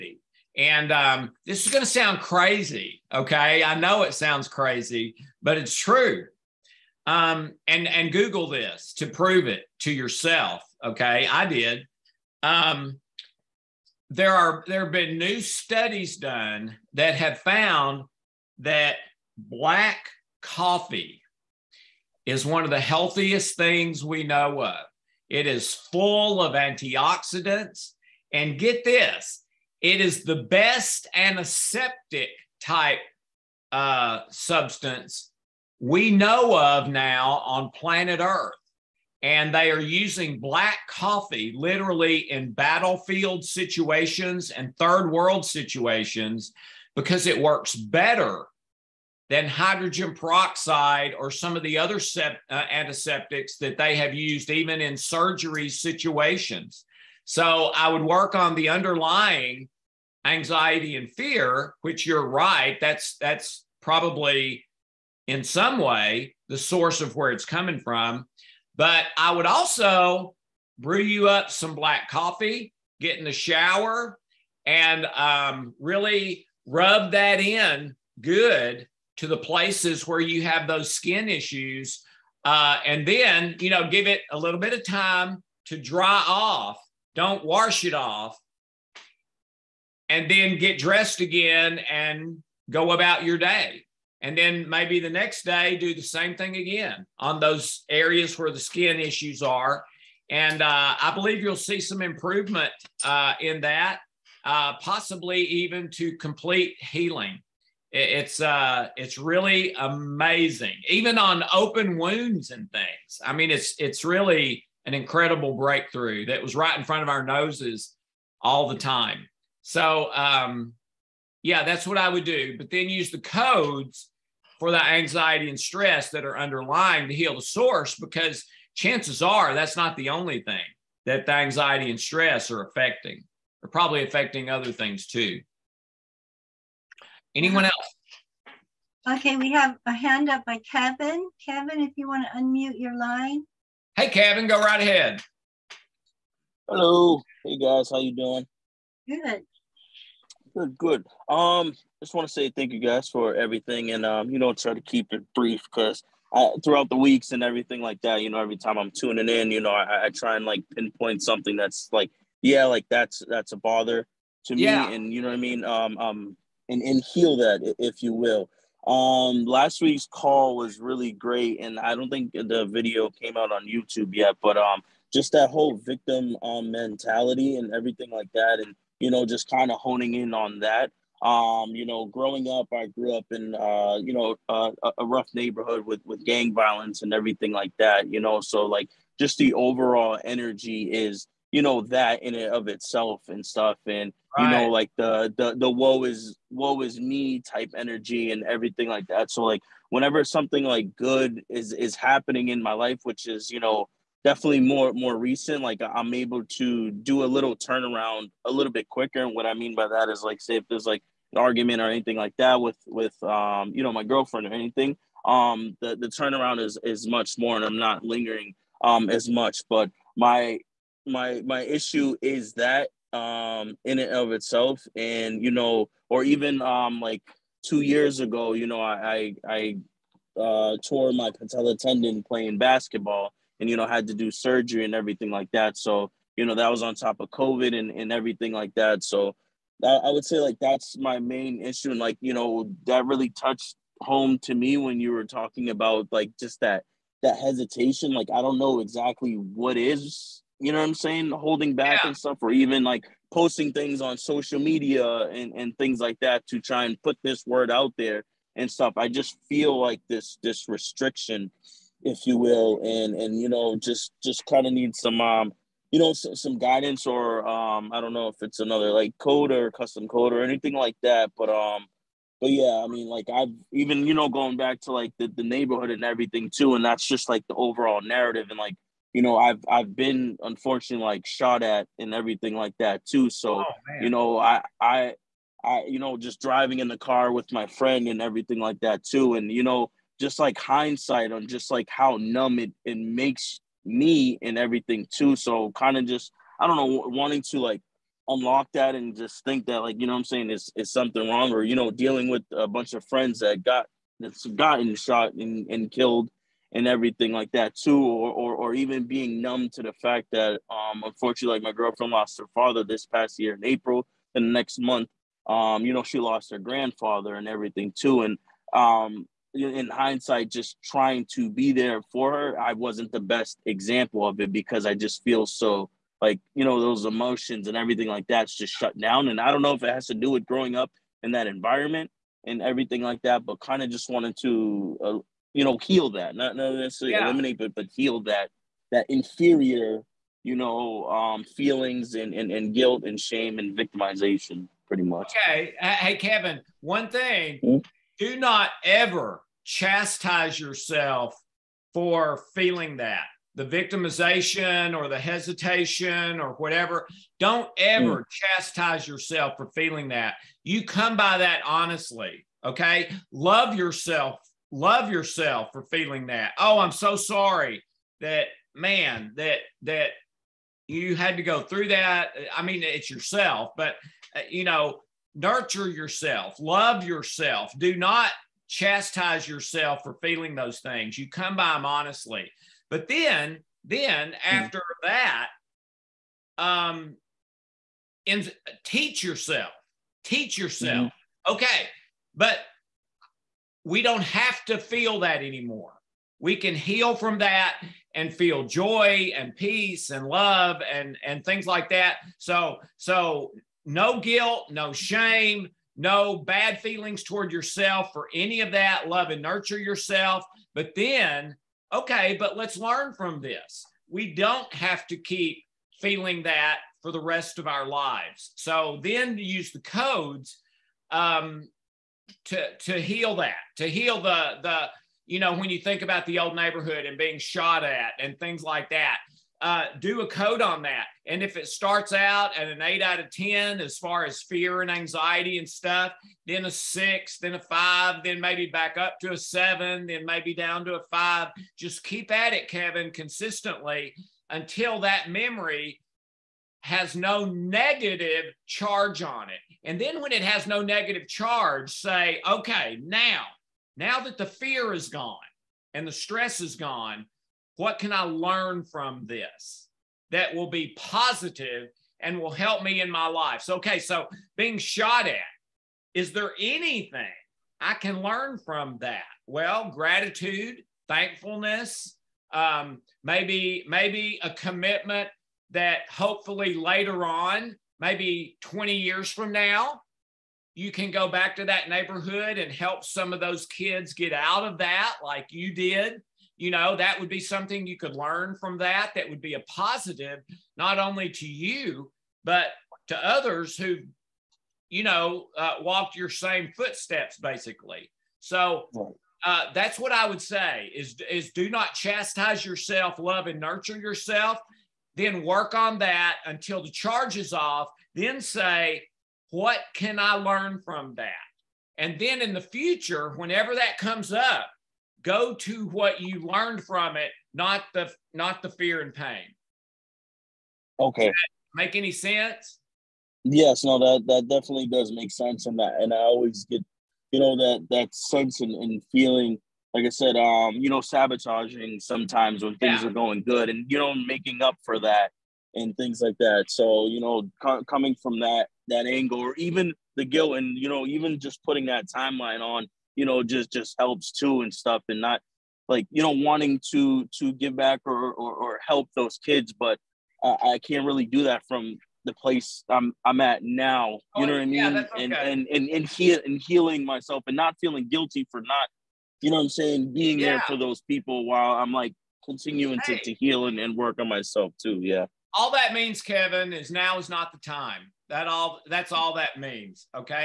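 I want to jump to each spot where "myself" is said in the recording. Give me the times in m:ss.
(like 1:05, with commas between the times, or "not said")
9:17, 9:24.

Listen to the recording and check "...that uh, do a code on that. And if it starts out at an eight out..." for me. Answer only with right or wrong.
right.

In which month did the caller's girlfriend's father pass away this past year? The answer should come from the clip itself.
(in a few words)
April.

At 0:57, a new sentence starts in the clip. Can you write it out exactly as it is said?
So I would work on the underlying anxiety and fear, which you're right.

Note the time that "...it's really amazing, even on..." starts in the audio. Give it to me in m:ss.
1:48.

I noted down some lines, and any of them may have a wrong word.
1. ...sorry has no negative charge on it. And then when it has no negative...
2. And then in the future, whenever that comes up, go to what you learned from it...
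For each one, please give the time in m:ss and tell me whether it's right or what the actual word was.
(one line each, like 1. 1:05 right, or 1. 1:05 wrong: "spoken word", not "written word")
1. 7:25 wrong: "memory", not "sorry"
2. 8:31 right.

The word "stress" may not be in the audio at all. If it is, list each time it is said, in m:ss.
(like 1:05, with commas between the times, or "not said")
2:05, 2:11, 7:36.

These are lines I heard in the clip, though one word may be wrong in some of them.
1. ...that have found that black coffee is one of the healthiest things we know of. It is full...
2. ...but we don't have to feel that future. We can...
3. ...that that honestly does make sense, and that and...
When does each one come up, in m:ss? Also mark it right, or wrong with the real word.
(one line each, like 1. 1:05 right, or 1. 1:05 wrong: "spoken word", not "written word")
1. 0:16 right
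2. 6:32 wrong: "anymore", not "future"
3. 8:43 wrong: "definitely", not "honestly".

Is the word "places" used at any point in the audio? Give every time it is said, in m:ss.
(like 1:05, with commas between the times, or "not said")
1:19, 9:12.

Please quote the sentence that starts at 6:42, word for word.
So so no guilt, no shame, no bad feelings toward yourself for any of that.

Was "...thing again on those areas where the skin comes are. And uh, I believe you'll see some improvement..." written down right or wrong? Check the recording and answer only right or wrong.
wrong.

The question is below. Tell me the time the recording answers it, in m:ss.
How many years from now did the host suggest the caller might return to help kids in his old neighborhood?
7:58.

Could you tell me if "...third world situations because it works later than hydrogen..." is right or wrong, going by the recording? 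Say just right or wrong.
wrong.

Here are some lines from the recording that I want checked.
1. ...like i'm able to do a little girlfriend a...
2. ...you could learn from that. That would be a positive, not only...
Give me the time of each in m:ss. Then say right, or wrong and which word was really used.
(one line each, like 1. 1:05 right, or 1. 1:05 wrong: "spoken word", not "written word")
1. 3:25 wrong: "turnaround", not "girlfriend"
2. 8:07 right.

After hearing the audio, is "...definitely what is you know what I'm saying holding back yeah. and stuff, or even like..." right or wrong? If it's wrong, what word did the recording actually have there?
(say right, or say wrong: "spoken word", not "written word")
wrong: "exactly", not "definitely".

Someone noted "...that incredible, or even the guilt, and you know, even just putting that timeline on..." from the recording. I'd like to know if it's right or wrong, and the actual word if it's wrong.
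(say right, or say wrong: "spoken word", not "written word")
wrong: "angle", not "incredible".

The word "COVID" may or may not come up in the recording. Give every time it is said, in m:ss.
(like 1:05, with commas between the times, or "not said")
3:57.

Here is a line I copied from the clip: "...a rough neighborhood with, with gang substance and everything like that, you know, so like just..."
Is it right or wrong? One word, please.
wrong.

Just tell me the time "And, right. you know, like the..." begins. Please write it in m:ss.
3:13.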